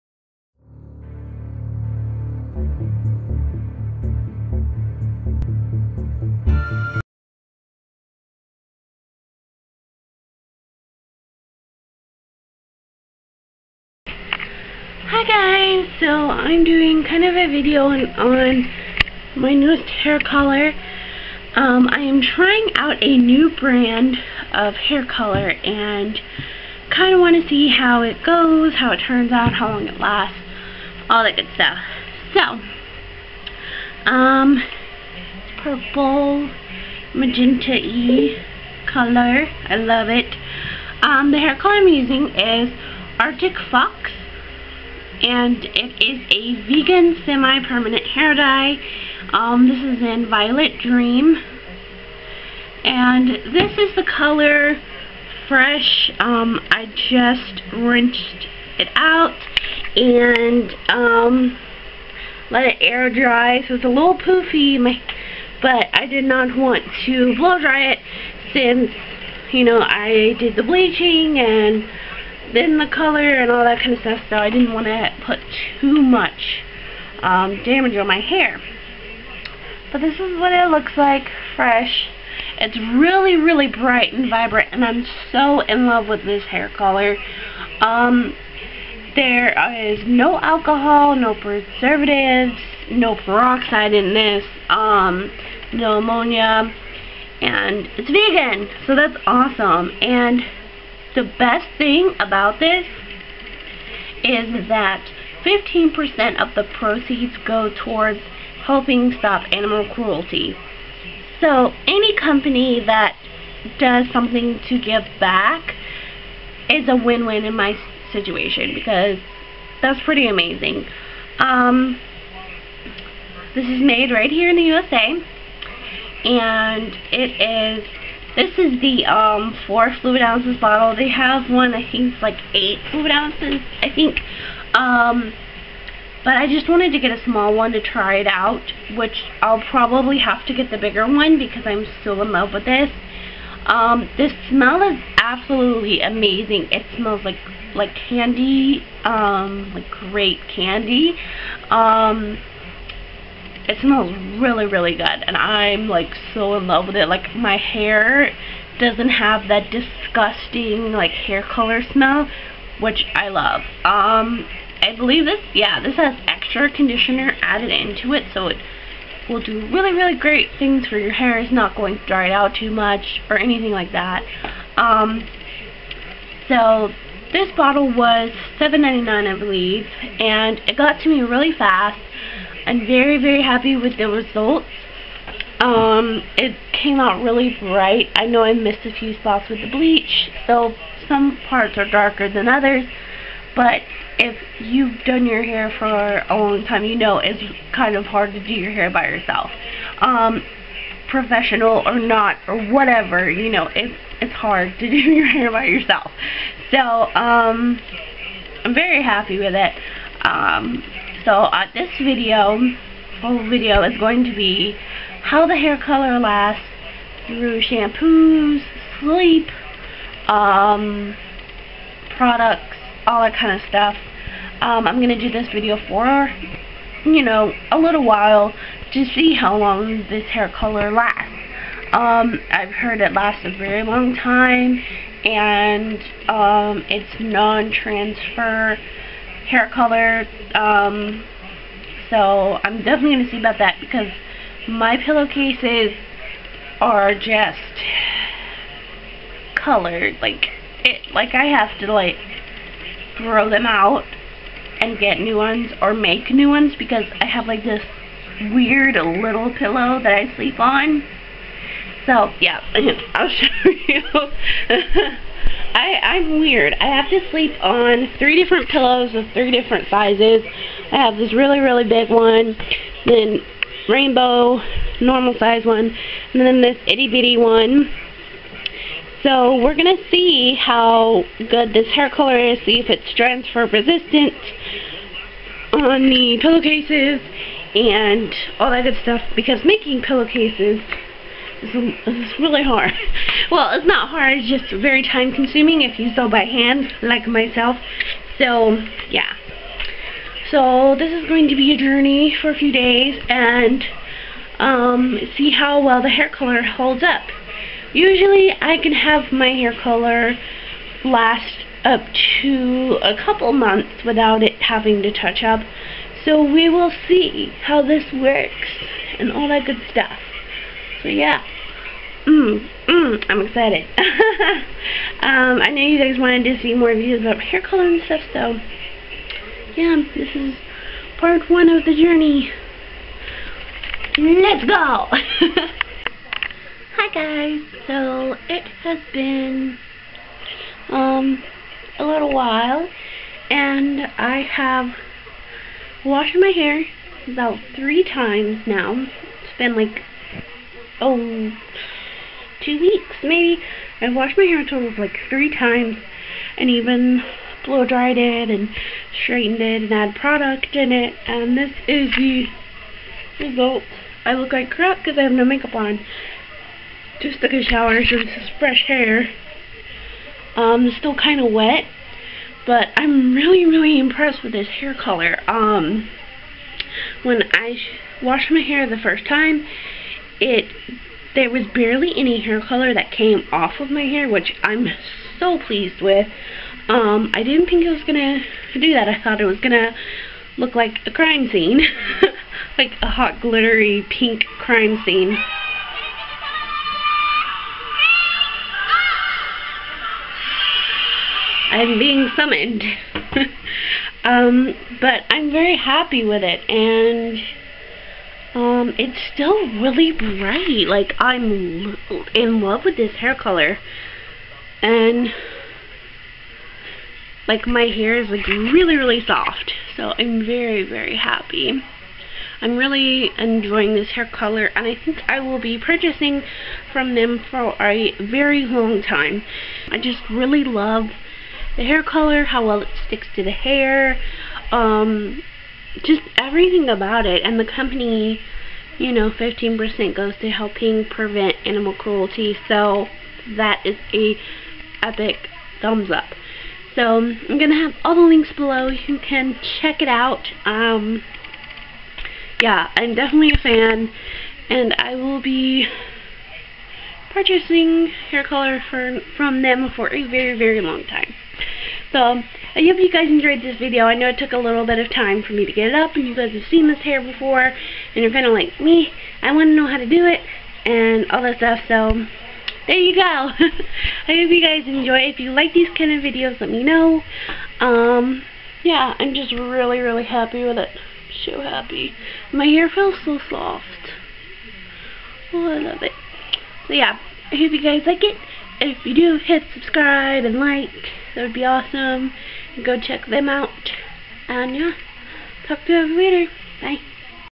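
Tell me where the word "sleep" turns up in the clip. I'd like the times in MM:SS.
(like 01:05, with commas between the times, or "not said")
03:38, 04:20, 04:27.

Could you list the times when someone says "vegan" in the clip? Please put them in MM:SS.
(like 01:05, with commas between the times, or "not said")
00:46, 01:38.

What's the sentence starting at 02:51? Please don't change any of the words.
It's not going to dry it out too much or anything like that.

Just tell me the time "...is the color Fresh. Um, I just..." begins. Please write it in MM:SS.
00:53.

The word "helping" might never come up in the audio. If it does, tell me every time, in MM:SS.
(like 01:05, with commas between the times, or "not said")
01:48, 07:20.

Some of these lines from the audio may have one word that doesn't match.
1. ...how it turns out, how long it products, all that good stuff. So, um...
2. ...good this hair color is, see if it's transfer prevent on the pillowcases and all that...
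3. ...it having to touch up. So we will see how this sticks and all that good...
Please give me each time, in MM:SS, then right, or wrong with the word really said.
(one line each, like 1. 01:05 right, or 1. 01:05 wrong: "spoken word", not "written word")
1. 00:28 wrong: "lasts", not "products"
2. 04:41 wrong: "resistant", not "prevent"
3. 05:14 wrong: "works", not "sticks".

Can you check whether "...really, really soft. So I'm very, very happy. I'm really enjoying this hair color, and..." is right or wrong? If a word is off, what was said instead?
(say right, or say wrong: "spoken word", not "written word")
right.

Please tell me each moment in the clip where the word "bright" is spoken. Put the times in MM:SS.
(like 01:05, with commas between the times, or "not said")
01:23, 03:07, 06:50.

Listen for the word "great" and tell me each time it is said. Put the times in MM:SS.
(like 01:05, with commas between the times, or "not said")
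02:29, 02:50.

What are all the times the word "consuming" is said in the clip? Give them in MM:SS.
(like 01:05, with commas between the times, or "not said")
04:55.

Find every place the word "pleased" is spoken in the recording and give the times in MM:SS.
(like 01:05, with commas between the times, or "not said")
06:25.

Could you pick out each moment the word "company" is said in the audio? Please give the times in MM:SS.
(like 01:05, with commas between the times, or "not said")
01:52, 07:17.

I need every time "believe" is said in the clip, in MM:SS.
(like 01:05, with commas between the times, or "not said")
02:44, 02:59.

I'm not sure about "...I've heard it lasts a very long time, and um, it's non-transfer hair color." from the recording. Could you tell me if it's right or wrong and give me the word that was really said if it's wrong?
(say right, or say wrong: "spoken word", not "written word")
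right.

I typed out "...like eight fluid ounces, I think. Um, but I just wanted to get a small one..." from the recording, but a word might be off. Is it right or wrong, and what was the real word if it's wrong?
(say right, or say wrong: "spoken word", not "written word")
right.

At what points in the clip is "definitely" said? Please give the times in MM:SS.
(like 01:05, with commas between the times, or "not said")
04:02, 07:33.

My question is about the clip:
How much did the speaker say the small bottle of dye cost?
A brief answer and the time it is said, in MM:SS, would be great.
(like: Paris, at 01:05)
$7.99, at 02:58.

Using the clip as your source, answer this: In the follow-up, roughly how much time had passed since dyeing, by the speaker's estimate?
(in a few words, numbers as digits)
2 weeks.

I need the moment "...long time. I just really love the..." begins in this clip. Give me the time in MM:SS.
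07:08.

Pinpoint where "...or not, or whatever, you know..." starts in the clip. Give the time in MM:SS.
03:21.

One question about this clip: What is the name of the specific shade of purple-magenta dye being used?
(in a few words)
Violet Dream.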